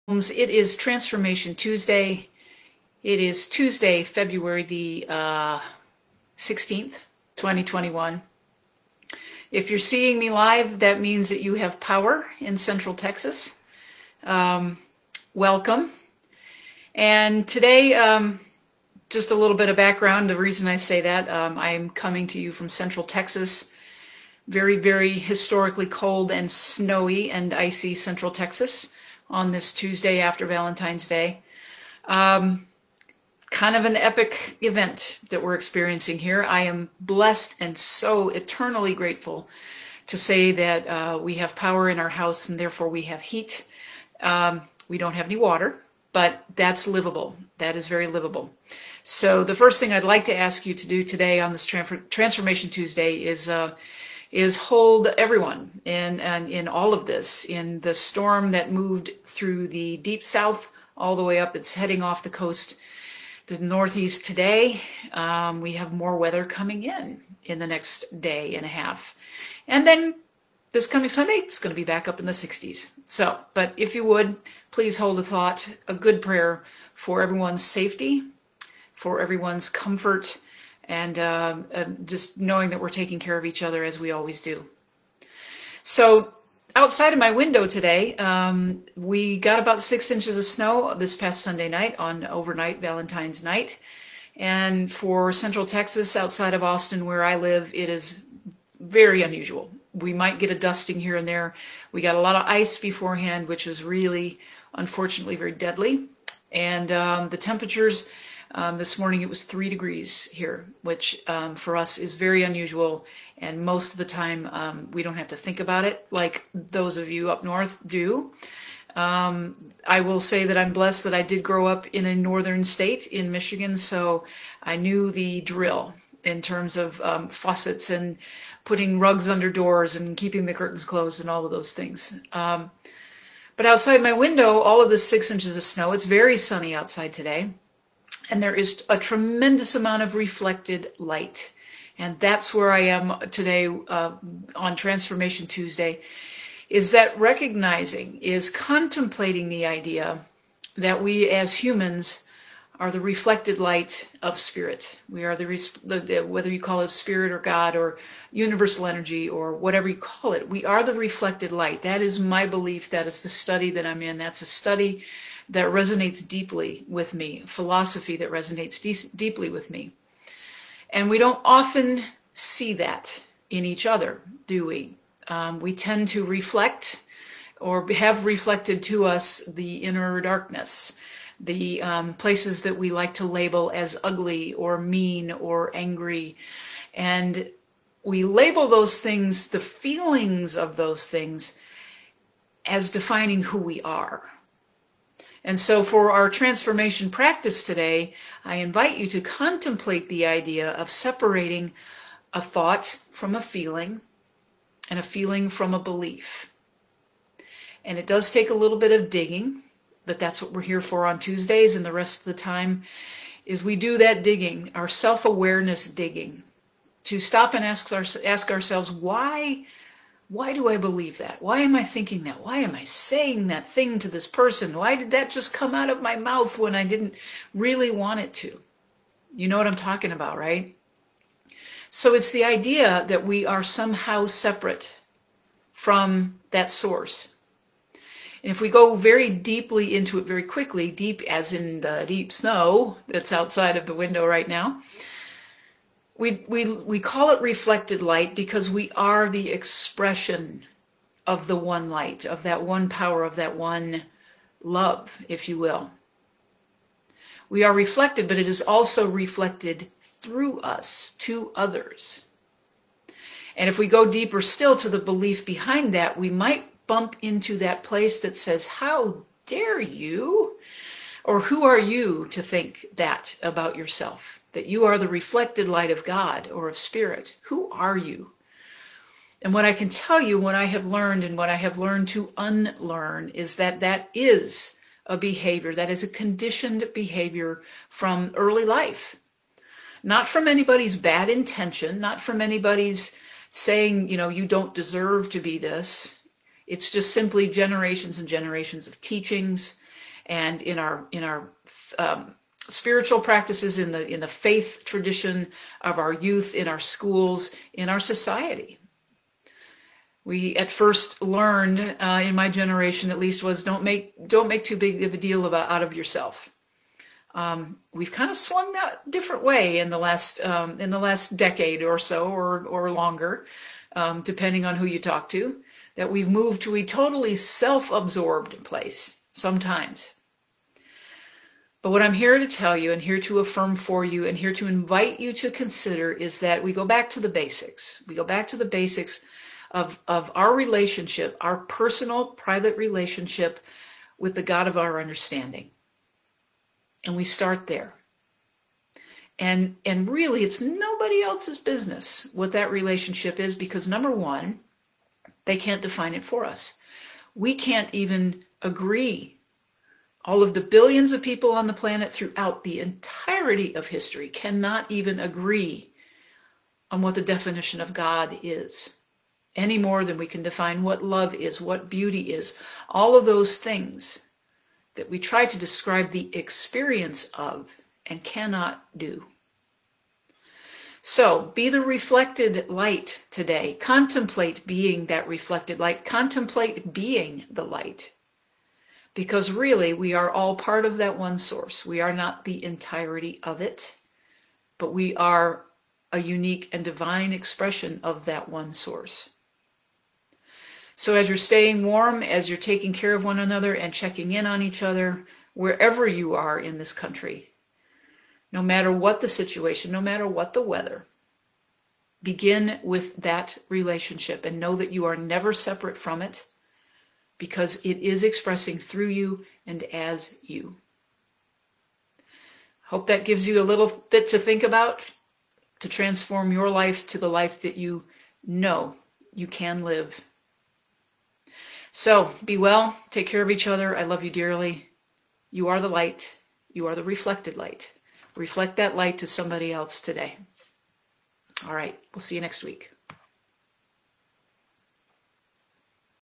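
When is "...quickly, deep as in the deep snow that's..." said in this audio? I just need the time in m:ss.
4:00.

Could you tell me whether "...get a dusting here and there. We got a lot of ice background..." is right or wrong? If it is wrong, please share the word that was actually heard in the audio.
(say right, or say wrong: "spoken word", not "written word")
wrong: "beforehand", not "background".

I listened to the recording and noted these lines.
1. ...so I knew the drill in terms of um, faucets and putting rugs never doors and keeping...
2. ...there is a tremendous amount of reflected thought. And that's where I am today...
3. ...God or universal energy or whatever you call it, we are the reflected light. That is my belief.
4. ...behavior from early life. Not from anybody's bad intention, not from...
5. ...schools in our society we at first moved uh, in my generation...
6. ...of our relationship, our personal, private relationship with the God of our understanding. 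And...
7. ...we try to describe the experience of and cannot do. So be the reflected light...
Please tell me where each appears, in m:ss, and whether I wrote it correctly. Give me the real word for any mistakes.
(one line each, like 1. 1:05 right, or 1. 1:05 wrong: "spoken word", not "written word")
1. 2:03 wrong: "under", not "never"
2. 2:18 wrong: "light", not "thought"
3. 2:37 right
4. 4:46 right
5. 5:06 wrong: "learned", not "moved"
6. 5:40 right
7. 6:15 right.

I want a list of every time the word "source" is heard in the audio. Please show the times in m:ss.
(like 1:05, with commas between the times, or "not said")
3:56, 6:31, 6:38.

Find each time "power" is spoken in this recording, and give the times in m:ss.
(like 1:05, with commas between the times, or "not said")
0:11, 0:41, 4:12.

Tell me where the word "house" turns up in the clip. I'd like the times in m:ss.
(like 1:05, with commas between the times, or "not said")
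0:42.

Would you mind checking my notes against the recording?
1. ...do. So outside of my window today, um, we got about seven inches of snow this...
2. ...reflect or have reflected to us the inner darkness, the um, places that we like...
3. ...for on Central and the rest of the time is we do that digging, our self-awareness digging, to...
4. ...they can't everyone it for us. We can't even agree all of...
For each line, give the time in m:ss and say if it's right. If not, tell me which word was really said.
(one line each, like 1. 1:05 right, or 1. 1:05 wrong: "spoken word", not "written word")
1. 1:24 wrong: "six", not "seven"
2. 2:56 right
3. 3:30 wrong: "Tuesdays", not "Central"
4. 5:55 wrong: "define", not "everyone".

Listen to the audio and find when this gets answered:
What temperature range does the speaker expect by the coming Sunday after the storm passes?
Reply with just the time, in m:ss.
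1:12.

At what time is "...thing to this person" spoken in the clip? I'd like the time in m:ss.
3:43.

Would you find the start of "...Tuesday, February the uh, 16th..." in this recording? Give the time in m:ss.
0:03.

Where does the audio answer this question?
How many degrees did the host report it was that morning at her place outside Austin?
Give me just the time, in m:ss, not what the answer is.
1:49.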